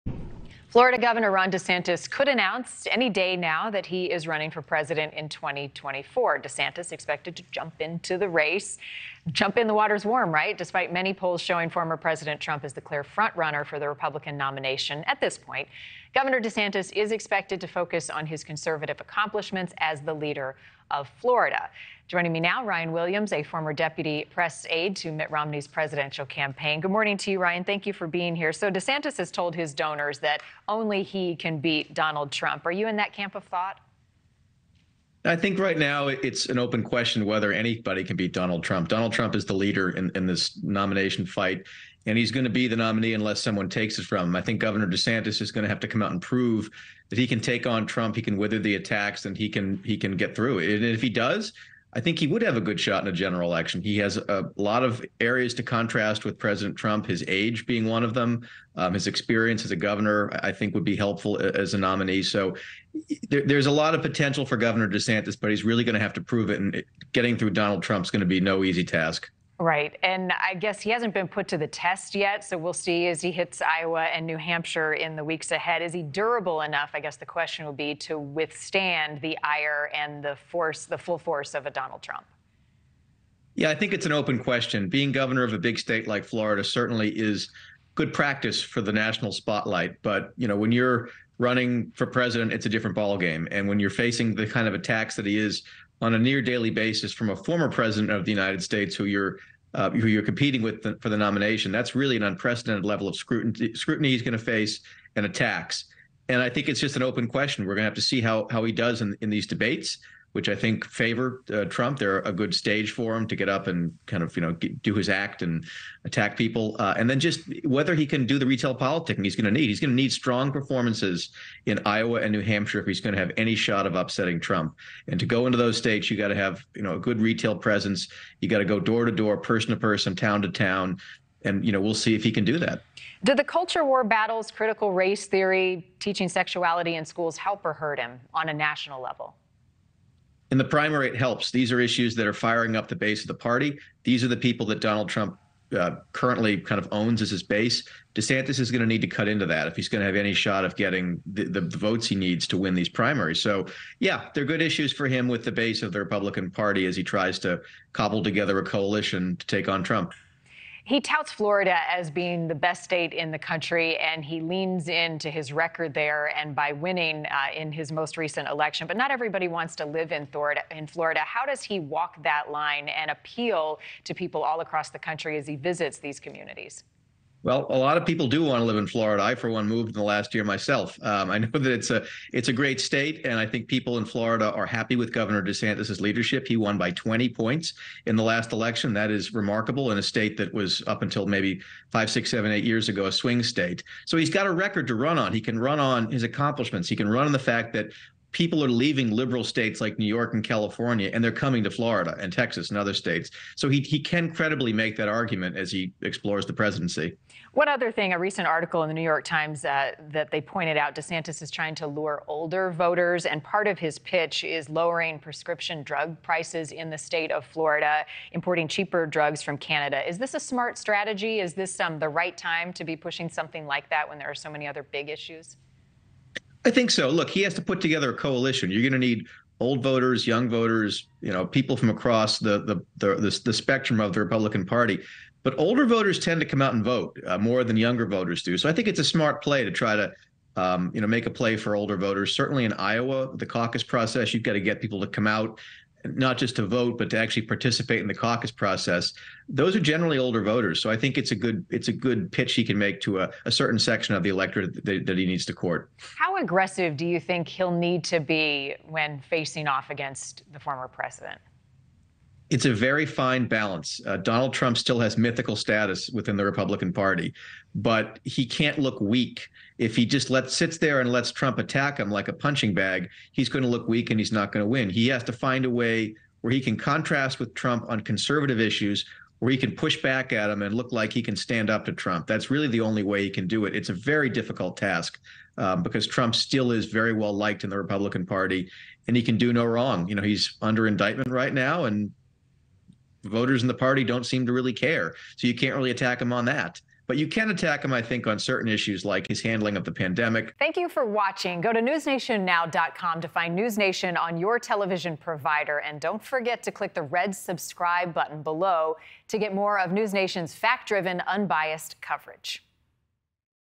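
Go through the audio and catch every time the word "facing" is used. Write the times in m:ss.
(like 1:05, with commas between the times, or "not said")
1:33, 4:19.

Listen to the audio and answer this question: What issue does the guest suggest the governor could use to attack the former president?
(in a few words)
handling of the pandemic.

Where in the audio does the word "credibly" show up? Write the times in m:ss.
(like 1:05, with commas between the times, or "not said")
3:24.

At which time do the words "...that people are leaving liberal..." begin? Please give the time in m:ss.
3:17.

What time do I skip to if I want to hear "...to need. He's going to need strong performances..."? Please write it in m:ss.
1:59.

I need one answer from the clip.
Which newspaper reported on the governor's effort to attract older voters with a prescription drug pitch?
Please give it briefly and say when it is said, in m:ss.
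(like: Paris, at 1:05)
New York Times, at 3:28.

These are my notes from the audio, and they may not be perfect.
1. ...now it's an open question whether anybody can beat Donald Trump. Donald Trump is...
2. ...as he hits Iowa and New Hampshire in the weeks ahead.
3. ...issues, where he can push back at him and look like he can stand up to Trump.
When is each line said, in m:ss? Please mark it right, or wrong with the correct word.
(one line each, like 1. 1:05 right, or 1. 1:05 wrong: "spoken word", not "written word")
1. 0:35 right
2. 1:13 right
3. 4:38 right.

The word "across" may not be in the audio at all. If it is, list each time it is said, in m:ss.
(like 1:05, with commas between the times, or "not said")
2:54, 3:51.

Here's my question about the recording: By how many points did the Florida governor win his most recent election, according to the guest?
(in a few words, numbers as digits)
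20.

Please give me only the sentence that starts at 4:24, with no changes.
Uh, Donald Trump still has mythical status within the Republican Party, but he can't look weak.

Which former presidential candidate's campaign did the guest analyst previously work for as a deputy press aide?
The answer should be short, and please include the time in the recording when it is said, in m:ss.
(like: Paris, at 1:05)
Mitt Romney, at 0:25.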